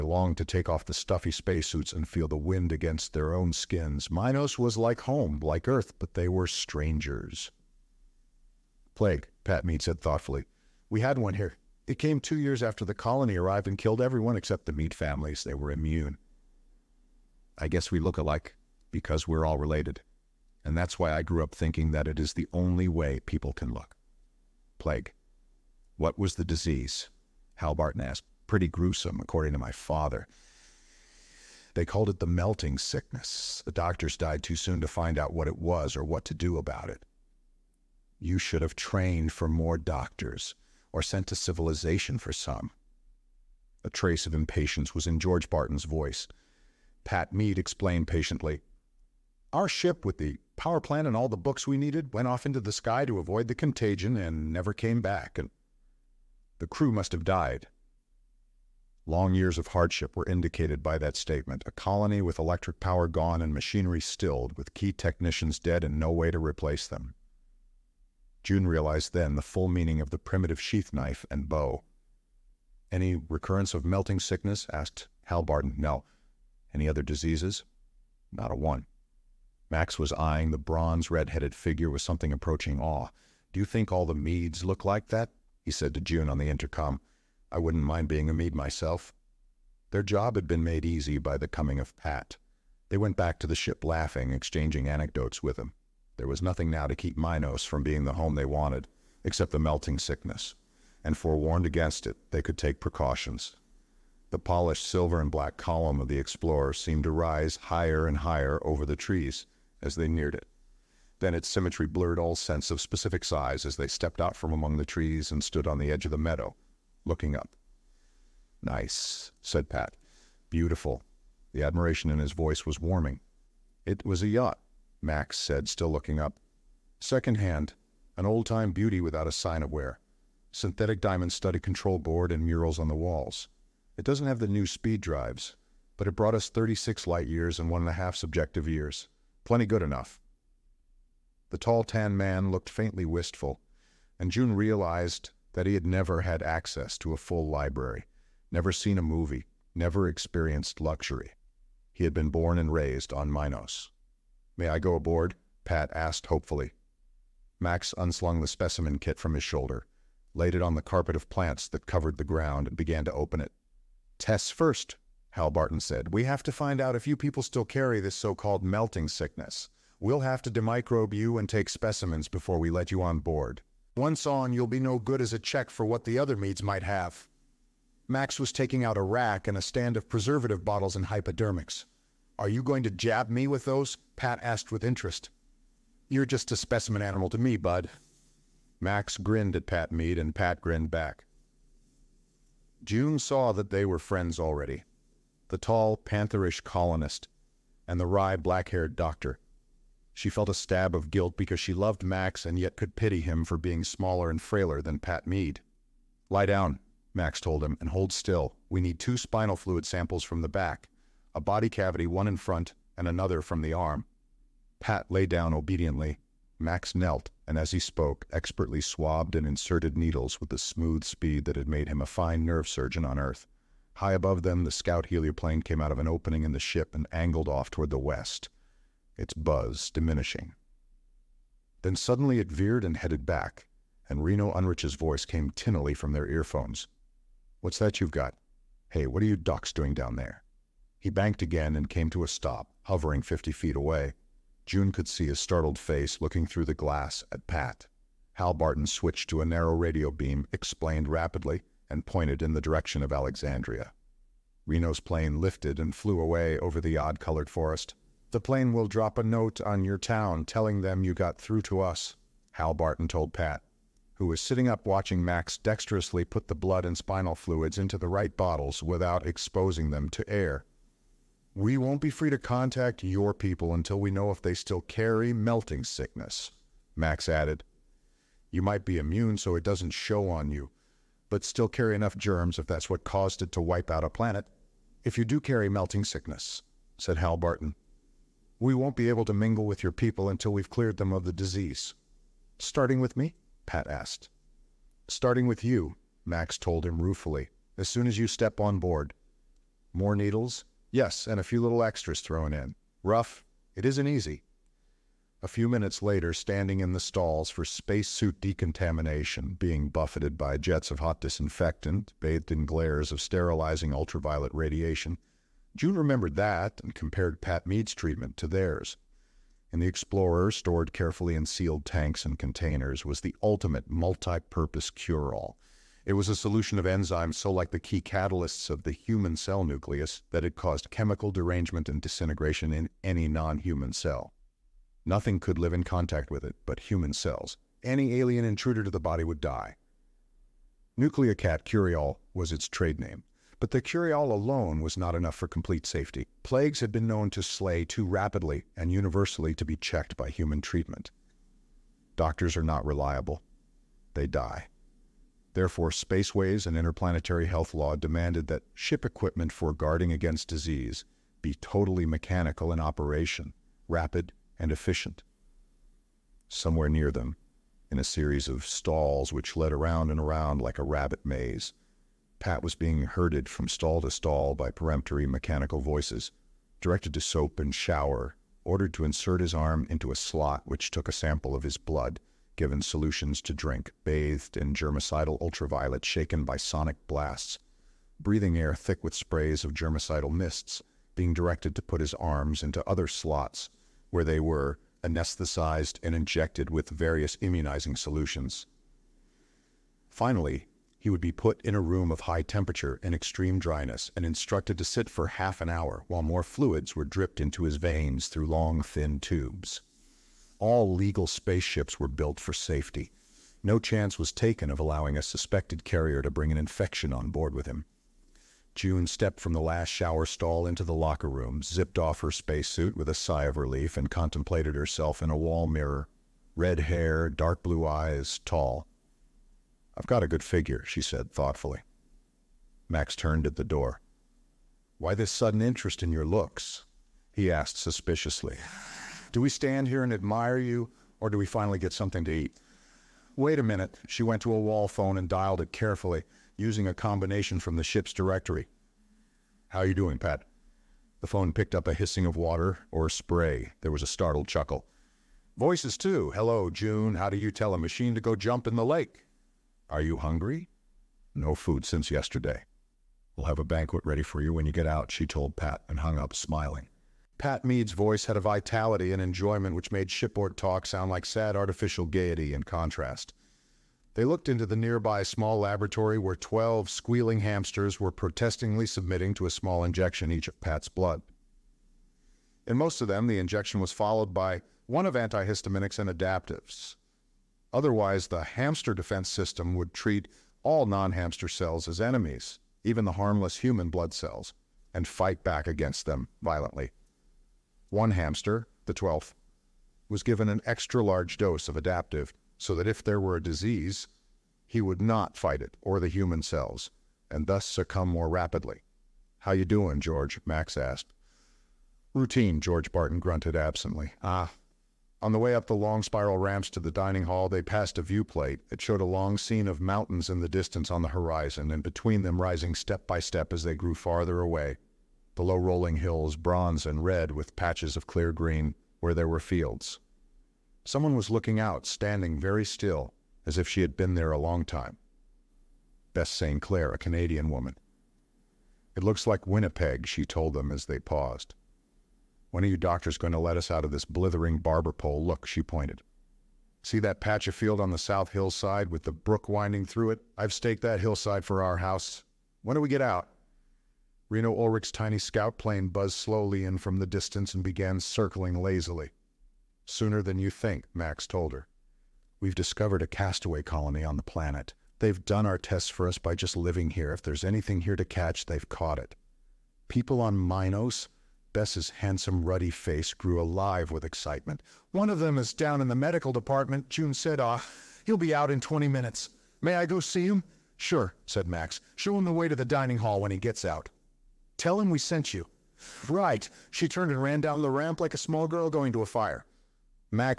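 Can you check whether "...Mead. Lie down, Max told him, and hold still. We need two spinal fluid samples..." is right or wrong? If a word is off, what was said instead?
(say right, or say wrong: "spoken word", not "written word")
right.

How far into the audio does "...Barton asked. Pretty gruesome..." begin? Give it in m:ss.
0:27.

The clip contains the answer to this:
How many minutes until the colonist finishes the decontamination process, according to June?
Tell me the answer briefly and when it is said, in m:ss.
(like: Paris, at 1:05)
20, at 9:38.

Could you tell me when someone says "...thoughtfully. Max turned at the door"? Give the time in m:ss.
7:11.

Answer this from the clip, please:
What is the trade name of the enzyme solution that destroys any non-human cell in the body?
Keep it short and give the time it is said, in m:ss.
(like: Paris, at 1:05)
Nucleocat Cureall, at 5:40.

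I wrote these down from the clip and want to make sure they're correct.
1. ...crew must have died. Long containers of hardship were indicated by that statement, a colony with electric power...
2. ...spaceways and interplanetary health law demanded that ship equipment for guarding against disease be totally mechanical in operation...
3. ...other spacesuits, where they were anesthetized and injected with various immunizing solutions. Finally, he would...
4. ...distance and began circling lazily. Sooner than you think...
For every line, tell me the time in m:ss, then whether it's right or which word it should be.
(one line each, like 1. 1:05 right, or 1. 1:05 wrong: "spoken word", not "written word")
1. 0:56 wrong: "years", not "containers"
2. 5:55 right
3. 6:32 wrong: "slots", not "spacesuits"
4. 9:17 right.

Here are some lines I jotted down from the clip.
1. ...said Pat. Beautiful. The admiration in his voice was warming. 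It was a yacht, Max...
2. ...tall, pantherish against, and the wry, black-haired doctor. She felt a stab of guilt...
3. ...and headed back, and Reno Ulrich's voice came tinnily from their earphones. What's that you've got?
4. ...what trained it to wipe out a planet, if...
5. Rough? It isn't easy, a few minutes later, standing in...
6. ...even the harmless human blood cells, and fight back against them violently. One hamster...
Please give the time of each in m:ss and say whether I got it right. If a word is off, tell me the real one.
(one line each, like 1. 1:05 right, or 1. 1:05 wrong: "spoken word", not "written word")
1. 1:59 right
2. 3:15 wrong: "colonist", not "against"
3. 3:52 right
4. 4:42 wrong: "caused", not "trained"
5. 5:03 right
6. 8:12 right.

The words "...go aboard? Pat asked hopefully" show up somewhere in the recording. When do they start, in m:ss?
2:34.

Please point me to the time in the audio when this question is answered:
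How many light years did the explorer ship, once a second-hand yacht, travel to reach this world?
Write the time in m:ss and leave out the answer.
2:16.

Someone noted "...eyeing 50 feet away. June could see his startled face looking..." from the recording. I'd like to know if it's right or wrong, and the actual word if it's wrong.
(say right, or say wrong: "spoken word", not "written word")
wrong: "hovering", not "eyeing".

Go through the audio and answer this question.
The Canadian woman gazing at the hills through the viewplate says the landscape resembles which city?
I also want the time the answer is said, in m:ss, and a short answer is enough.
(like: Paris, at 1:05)
Winnipeg, at 8:59.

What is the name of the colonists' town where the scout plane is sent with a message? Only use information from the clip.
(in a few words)
Alexandria.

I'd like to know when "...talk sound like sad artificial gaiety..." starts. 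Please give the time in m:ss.
7:50.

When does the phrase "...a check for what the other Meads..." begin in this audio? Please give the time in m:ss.
2:55.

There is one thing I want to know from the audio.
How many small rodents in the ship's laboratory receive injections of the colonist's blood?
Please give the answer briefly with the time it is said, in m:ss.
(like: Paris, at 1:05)
12, at 7:56.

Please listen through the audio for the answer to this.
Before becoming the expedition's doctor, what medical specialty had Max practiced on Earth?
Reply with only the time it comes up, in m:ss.
3:42.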